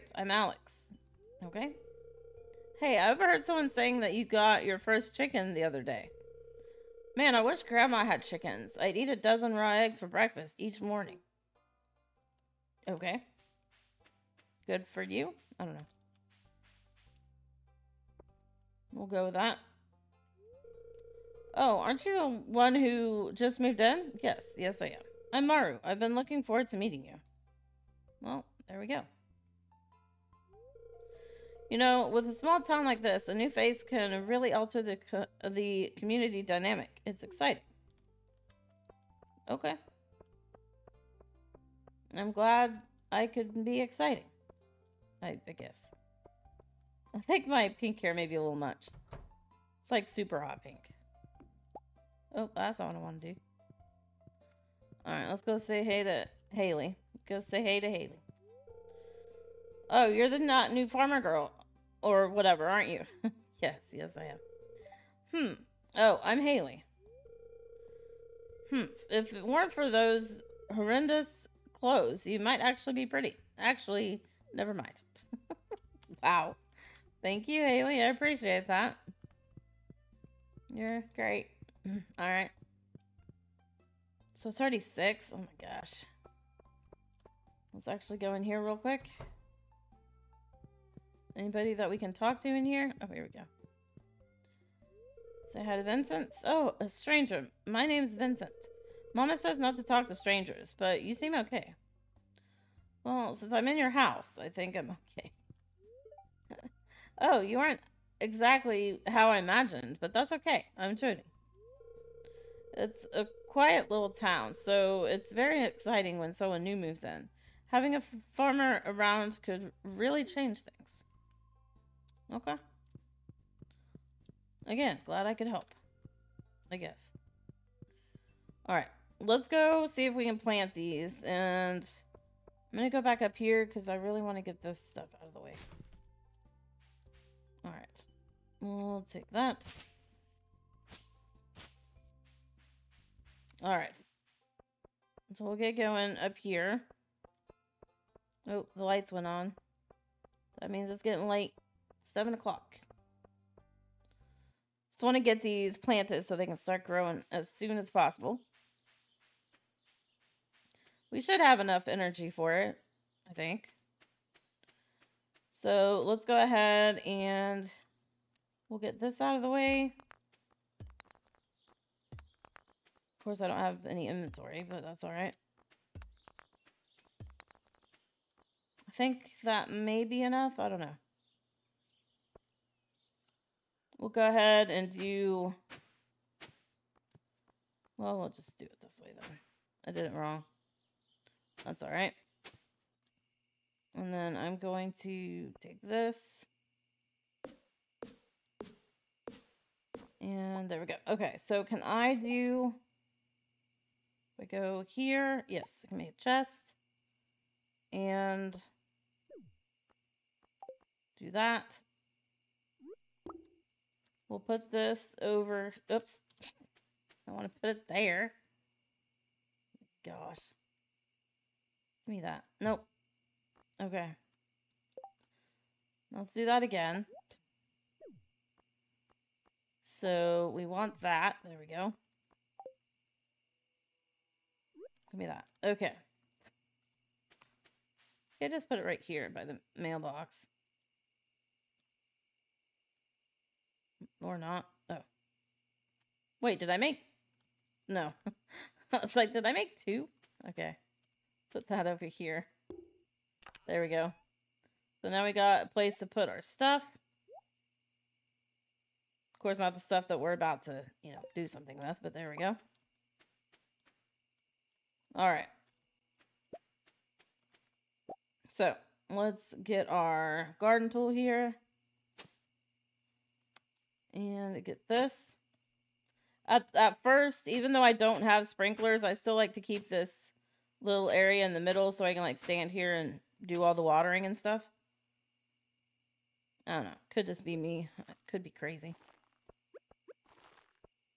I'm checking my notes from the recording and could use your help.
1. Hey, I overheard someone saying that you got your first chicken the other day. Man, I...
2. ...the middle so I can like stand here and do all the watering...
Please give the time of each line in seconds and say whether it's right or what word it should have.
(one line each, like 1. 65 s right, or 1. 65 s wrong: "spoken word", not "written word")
1. 2 s right
2. 281 s right.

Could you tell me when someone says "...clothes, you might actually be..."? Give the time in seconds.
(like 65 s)
71 s.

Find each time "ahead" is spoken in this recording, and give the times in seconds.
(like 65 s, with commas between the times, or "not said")
166 s, 184 s.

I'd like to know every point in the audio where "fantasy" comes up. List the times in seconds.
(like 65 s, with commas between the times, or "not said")
not said.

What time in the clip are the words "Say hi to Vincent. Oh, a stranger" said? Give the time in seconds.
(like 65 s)
95 s.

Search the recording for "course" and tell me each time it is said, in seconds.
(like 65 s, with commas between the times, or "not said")
173 s, 259 s.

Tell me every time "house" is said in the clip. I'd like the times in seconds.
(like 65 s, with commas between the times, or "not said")
103 s.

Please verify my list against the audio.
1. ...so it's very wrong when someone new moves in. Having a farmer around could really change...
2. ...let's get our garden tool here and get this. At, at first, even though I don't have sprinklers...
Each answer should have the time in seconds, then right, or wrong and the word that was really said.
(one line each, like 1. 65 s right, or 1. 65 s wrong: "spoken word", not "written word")
1. 114 s wrong: "exciting", not "wrong"
2. 269 s right.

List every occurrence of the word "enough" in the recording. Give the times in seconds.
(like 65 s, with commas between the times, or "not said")
161 s, 180 s.